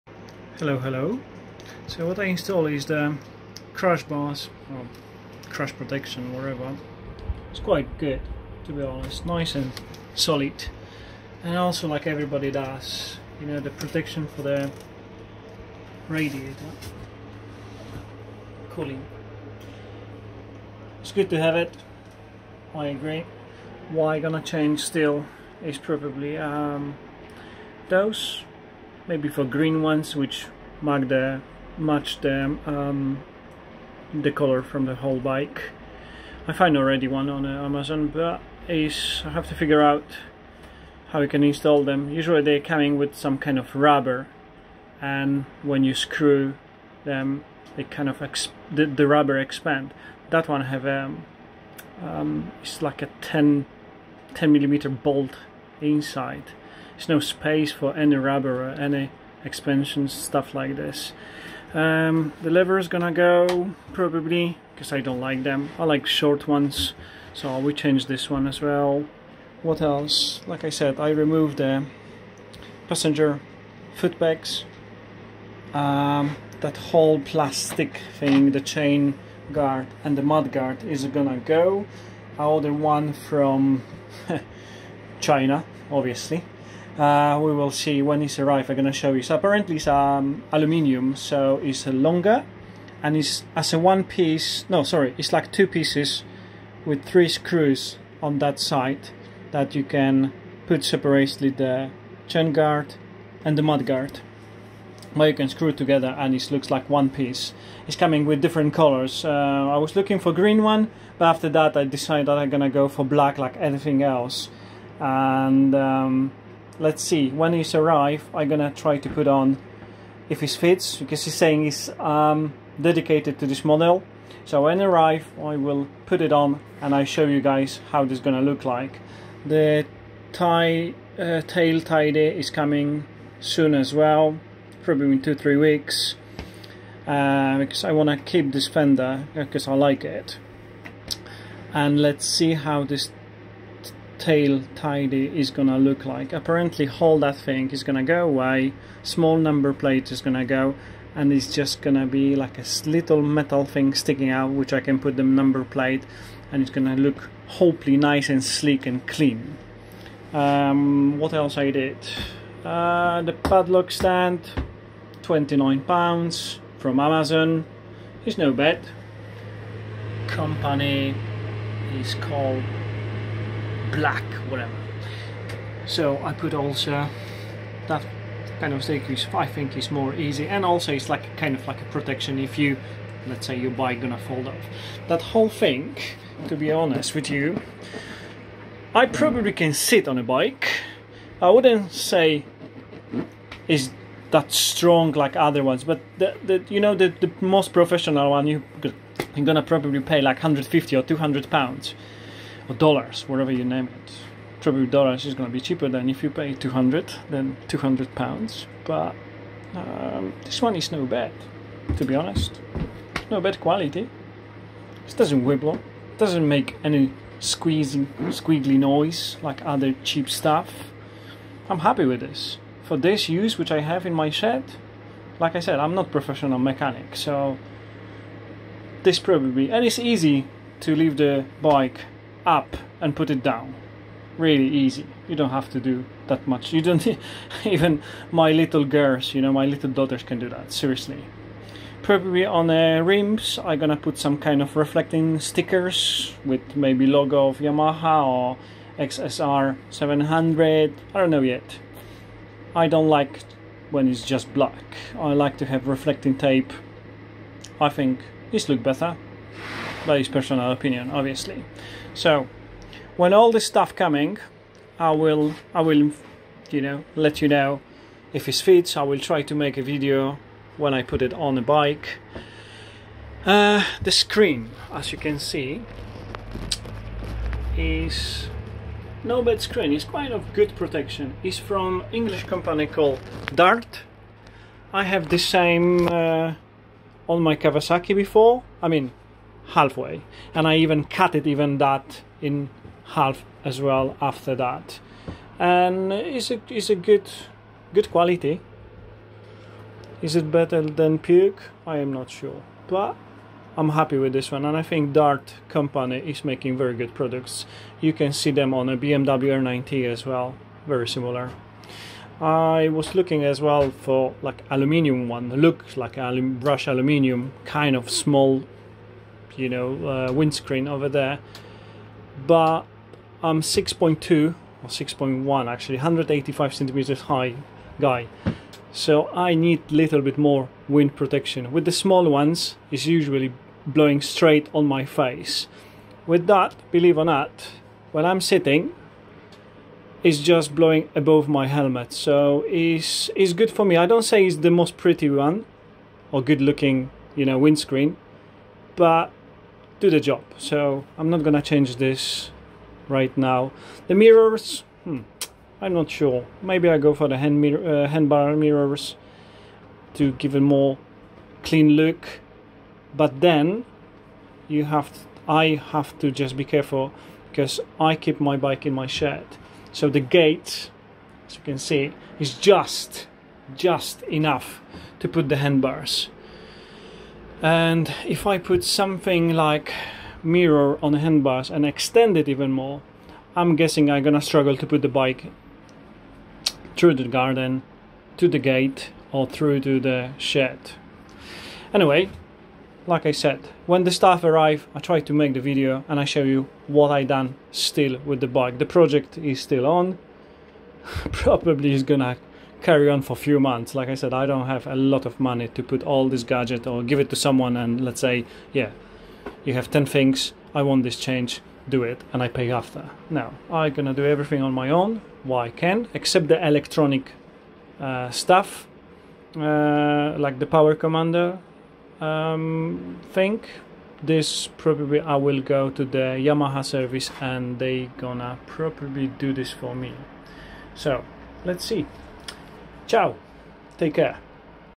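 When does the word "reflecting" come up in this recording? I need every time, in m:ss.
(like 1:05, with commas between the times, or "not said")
4:04, 4:15.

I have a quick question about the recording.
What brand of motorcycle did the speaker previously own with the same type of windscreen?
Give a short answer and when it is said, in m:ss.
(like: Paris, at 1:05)
Kawasaki, at 4:47.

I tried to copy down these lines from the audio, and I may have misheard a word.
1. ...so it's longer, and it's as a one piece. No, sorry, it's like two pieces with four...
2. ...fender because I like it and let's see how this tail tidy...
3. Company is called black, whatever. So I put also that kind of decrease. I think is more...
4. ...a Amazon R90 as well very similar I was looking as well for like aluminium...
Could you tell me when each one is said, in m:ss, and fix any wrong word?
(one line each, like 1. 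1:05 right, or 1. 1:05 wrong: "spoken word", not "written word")
1. 1:31 wrong: "three", not "four"
2. 2:18 right
3. 2:50 right
4. 5:08 wrong: "BMW", not "Amazon".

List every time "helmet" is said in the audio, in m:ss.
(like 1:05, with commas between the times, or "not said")
5:41.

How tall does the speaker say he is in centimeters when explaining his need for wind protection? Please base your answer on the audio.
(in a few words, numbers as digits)
185 centimeters.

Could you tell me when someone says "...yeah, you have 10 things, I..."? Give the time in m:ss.
6:48.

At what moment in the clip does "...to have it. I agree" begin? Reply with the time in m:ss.
0:21.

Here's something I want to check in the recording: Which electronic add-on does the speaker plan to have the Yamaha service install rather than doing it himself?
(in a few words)
power commander.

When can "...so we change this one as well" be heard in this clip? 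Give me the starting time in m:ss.
1:07.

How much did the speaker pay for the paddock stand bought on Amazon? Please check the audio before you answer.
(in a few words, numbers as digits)
29 pounds.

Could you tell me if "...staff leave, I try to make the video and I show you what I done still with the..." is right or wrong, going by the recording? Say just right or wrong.
wrong.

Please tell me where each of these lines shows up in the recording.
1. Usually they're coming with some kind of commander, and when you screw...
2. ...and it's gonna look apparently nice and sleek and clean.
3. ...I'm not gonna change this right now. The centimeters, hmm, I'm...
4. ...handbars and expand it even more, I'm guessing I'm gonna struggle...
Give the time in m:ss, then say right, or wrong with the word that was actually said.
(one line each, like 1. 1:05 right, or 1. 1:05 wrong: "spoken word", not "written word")
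1. 0:42 wrong: "rubber", not "commander"
2. 2:36 wrong: "hopefully", not "apparently"
3. 5:51 wrong: "mirrors", not "centimeters"
4. 6:21 wrong: "extend", not "expand".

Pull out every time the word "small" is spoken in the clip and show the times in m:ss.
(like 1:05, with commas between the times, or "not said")
2:29, 5:18, 5:31.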